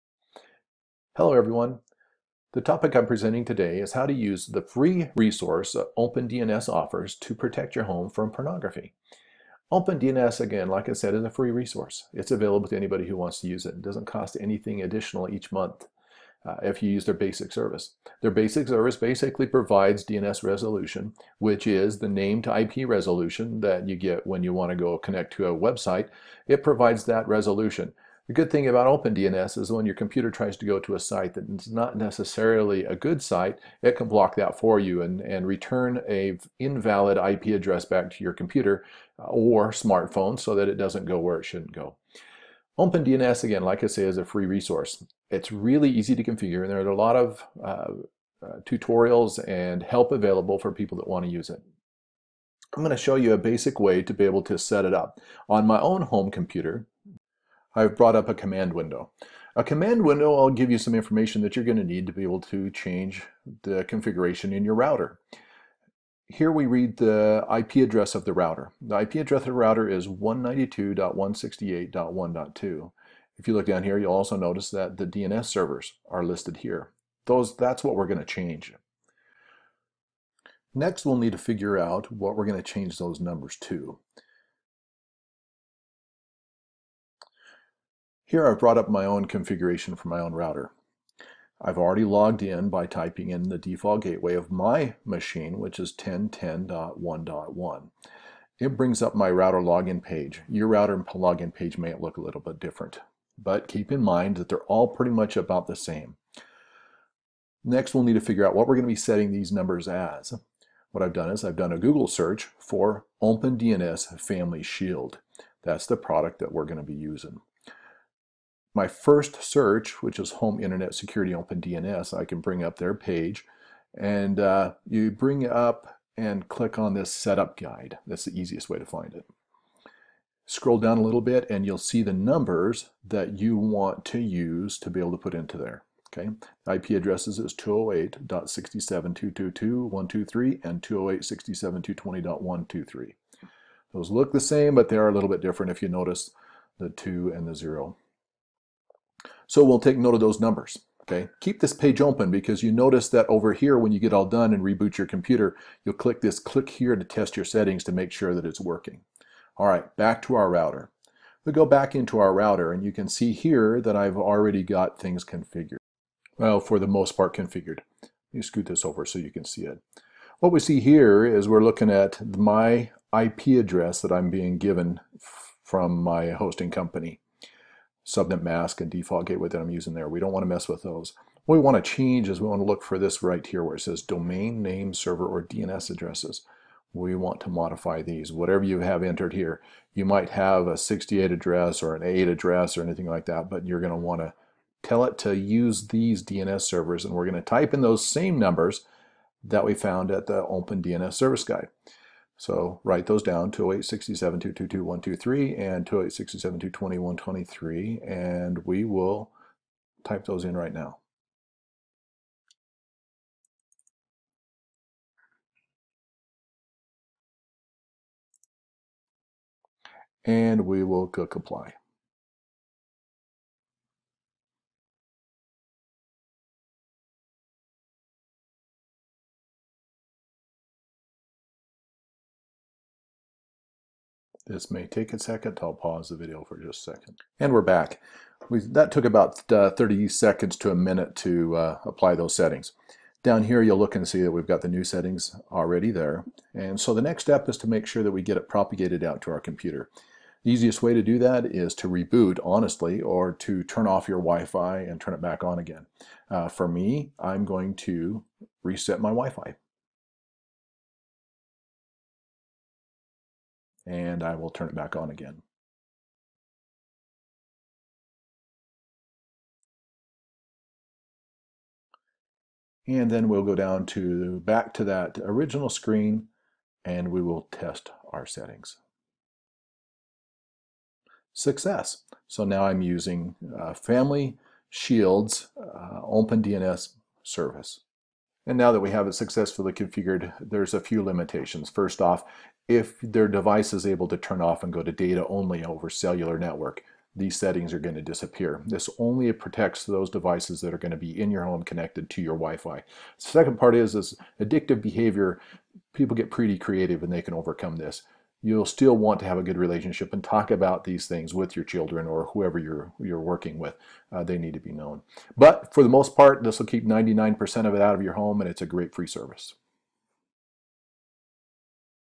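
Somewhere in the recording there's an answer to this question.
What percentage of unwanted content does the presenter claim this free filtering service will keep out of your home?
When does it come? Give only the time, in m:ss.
5:16.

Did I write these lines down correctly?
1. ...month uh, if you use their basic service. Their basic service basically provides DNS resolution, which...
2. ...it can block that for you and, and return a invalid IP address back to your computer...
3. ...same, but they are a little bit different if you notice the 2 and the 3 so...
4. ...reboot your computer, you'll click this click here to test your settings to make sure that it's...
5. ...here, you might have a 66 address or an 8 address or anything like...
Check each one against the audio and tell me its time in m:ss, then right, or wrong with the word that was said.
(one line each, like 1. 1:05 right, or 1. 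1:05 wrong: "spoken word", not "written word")
1. 0:15 right
2. 0:33 right
3. 2:24 wrong: "0", not "3"
4. 2:34 right
5. 3:09 wrong: "68", not "66".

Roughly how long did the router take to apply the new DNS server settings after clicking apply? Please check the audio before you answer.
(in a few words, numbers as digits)
30 seconds to a minute.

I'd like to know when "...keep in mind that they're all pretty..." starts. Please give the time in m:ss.
1:43.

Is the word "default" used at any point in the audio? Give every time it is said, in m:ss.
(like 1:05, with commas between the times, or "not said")
1:33, 2:58.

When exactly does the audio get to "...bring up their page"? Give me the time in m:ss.
2:02.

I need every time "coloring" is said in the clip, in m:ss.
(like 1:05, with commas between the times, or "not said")
not said.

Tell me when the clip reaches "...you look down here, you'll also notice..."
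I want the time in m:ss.
1:13.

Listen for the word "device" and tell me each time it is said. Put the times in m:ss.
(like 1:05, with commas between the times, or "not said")
4:53, 5:00.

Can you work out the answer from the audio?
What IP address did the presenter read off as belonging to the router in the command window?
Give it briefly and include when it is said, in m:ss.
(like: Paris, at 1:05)
192.168.1.2, at 1:10.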